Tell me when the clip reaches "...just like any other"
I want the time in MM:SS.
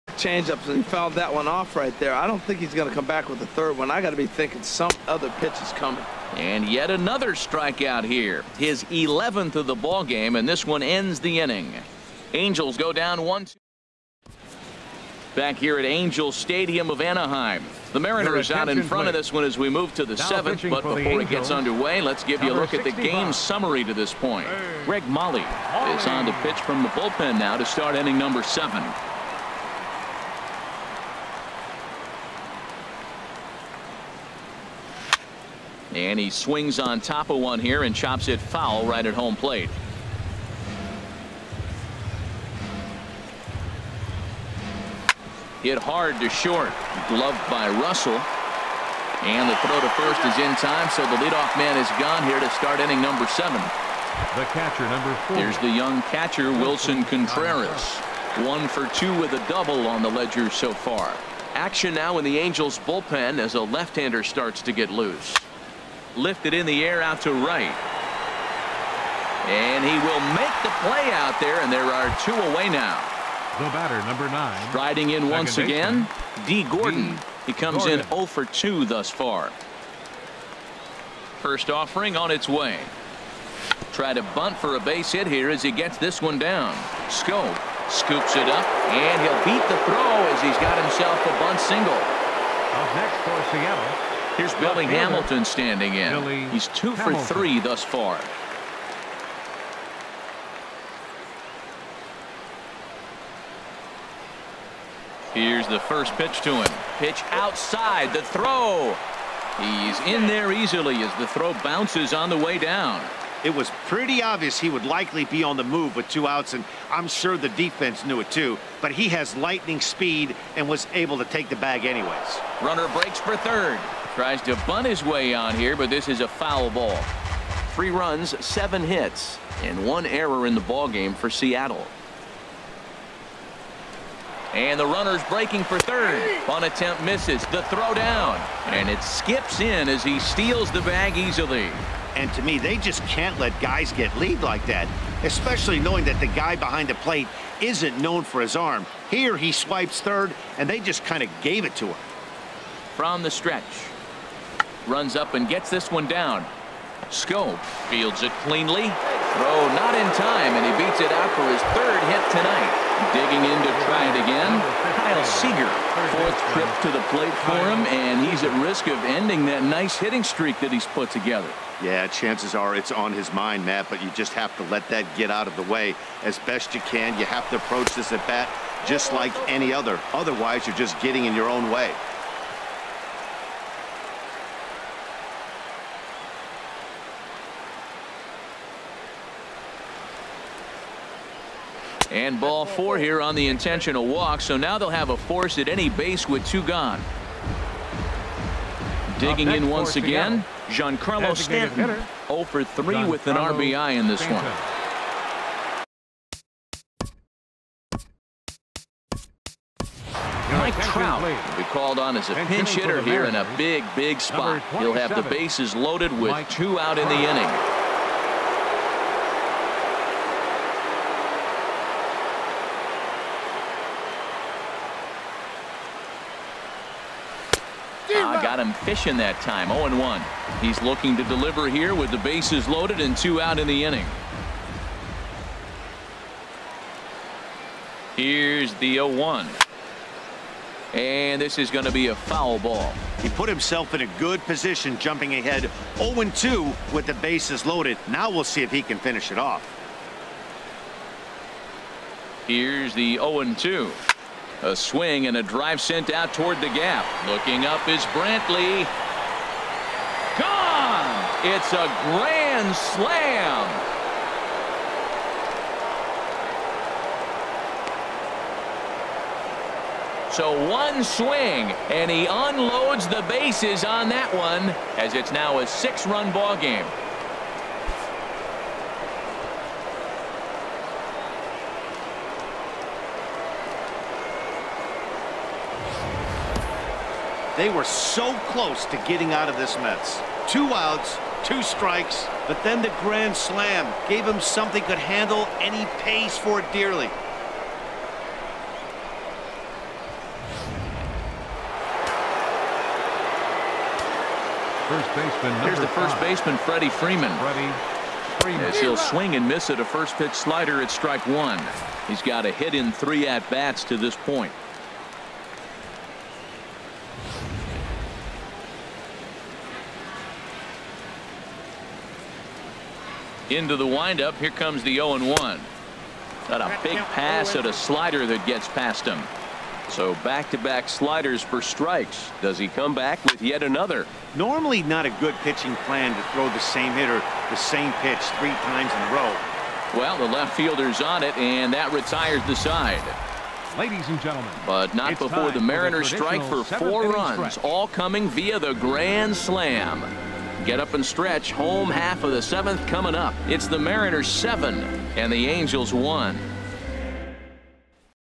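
02:58.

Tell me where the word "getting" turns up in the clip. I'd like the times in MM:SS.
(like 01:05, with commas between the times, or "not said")
03:01, 04:49.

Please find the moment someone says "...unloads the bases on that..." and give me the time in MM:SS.
04:32.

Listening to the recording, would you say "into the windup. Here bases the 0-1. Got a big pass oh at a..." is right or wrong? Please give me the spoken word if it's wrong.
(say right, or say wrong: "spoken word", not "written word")
wrong: "comes", not "bases".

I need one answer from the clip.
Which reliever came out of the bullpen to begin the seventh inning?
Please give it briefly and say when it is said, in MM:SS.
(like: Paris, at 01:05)
Greg Molly, at 00:24.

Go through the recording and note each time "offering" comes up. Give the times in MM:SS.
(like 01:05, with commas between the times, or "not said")
01:21.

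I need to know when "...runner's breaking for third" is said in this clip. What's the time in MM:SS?
02:14.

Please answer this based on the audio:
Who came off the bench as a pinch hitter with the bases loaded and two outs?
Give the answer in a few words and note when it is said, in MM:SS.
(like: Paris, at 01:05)
Mike Trout, at 03:30.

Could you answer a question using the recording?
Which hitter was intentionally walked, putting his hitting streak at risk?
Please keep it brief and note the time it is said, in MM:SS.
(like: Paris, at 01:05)
Kyle Seager, at 02:45.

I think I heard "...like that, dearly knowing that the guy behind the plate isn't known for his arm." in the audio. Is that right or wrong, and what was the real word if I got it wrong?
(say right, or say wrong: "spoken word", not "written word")
wrong: "especially", not "dearly".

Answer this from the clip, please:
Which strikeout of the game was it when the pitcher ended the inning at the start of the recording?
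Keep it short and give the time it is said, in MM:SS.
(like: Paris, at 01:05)
11th, at 00:08.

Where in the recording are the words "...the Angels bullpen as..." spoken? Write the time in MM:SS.
01:02.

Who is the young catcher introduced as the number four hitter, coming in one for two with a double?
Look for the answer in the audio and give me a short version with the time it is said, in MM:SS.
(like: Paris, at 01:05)
Wilson Contreras, at 00:56.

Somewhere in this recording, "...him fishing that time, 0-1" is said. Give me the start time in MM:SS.
03:48.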